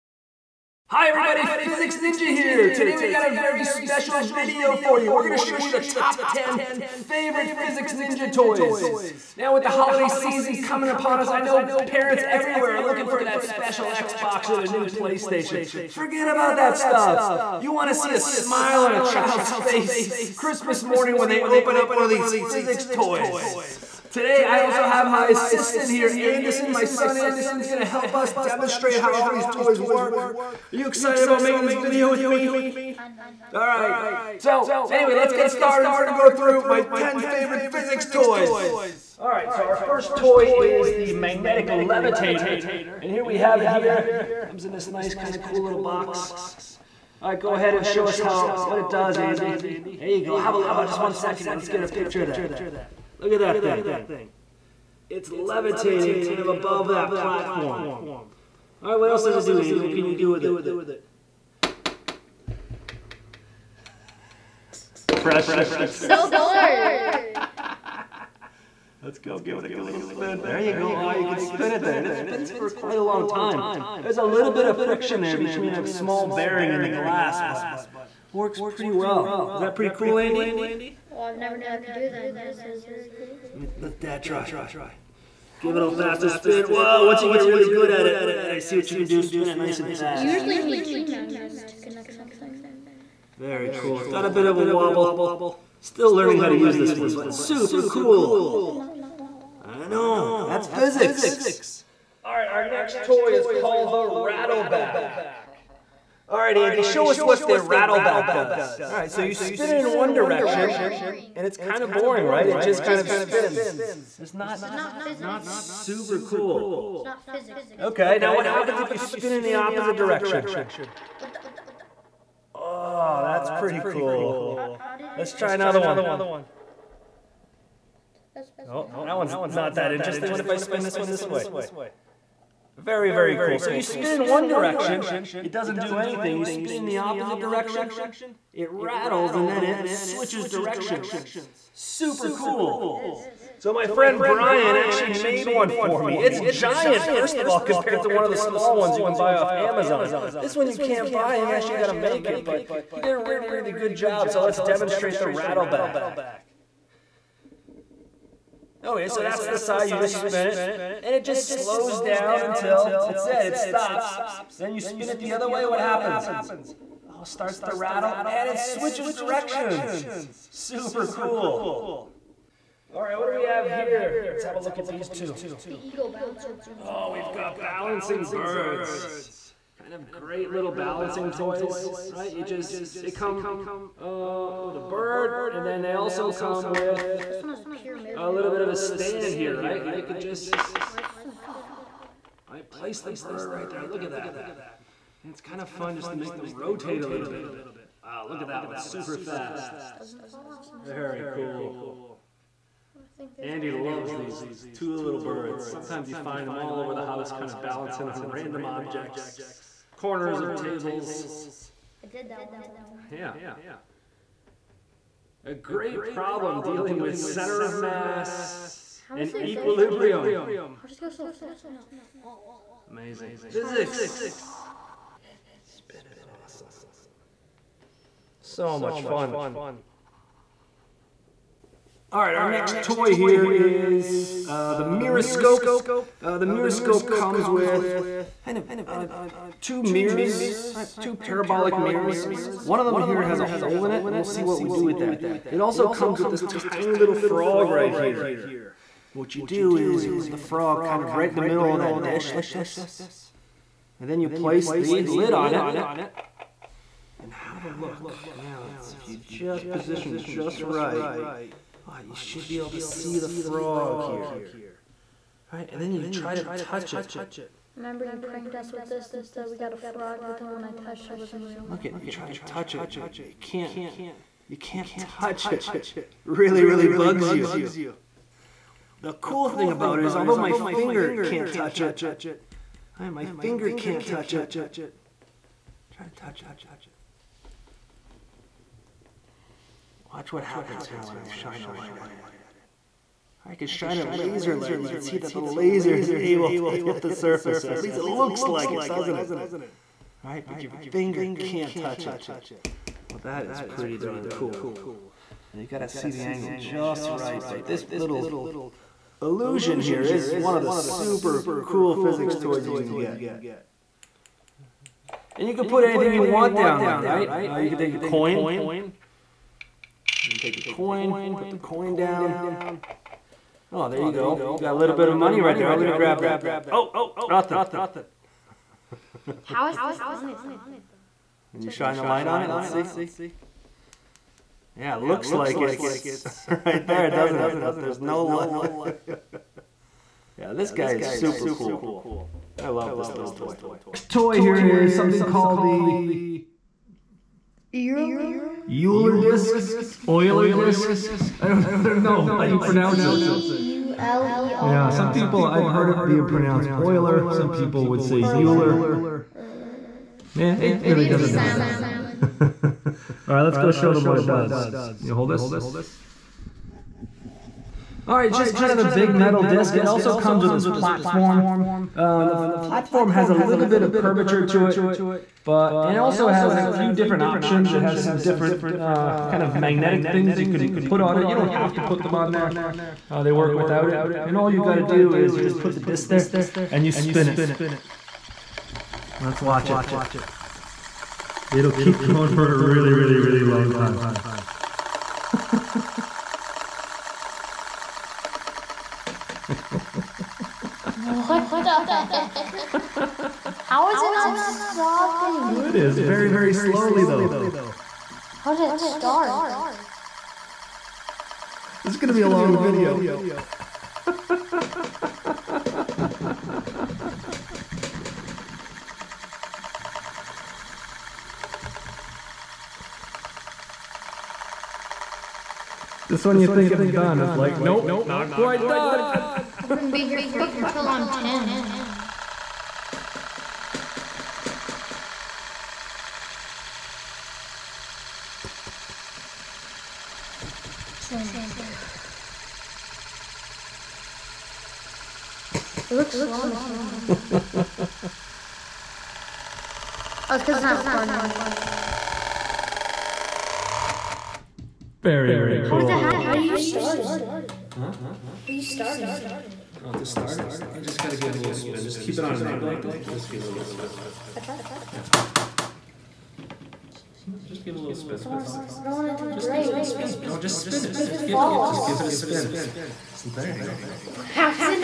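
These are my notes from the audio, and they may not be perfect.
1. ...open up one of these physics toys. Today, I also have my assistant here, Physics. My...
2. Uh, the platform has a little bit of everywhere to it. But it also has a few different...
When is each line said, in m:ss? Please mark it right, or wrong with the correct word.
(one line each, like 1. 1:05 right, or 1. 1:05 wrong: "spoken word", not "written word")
1. 0:21 wrong: "Anderson", not "Physics"
2. 6:11 wrong: "curvature", not "everywhere".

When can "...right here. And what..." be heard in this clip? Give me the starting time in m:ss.
4:07.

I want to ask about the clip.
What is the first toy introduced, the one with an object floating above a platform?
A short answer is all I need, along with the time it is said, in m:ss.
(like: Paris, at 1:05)
magnetic levitator, at 0:41.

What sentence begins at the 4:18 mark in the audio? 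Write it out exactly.
Now, if you just position just right, Oh, you should be able to see the frog here.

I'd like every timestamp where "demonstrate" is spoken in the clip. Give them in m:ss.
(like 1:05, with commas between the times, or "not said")
0:28, 2:34.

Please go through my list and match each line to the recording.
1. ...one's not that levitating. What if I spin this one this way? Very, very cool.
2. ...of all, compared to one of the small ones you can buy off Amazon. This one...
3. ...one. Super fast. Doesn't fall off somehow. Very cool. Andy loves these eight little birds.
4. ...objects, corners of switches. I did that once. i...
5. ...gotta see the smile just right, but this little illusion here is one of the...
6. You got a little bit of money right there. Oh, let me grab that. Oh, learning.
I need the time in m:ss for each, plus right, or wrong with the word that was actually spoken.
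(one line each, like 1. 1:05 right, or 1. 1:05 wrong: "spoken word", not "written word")
1. 2:09 wrong: "interesting", not "levitating"
2. 2:27 right
3. 3:18 wrong: "two", not "eight"
4. 3:28 wrong: "tables", not "switches"
5. 5:05 wrong: "angle", not "smile"
6. 5:24 wrong: "nothing", not "learning".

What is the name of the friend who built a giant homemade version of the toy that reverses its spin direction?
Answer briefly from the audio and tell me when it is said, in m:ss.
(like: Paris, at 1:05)
Brian, at 2:24.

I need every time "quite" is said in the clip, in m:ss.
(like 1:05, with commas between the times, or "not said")
1:12, 7:08.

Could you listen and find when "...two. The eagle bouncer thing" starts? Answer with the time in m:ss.
2:55.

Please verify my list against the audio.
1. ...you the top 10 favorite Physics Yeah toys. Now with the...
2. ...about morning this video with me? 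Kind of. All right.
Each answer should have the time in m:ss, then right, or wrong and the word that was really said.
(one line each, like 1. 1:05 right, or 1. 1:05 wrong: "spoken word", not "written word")
1. 0:05 wrong: "Ninja", not "Yeah"
2. 0:31 wrong: "making", not "morning".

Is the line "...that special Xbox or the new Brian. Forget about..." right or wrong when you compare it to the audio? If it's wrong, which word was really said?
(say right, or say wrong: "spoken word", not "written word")
wrong: "PlayStation", not "Brian".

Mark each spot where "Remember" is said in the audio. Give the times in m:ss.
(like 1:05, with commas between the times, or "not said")
4:27.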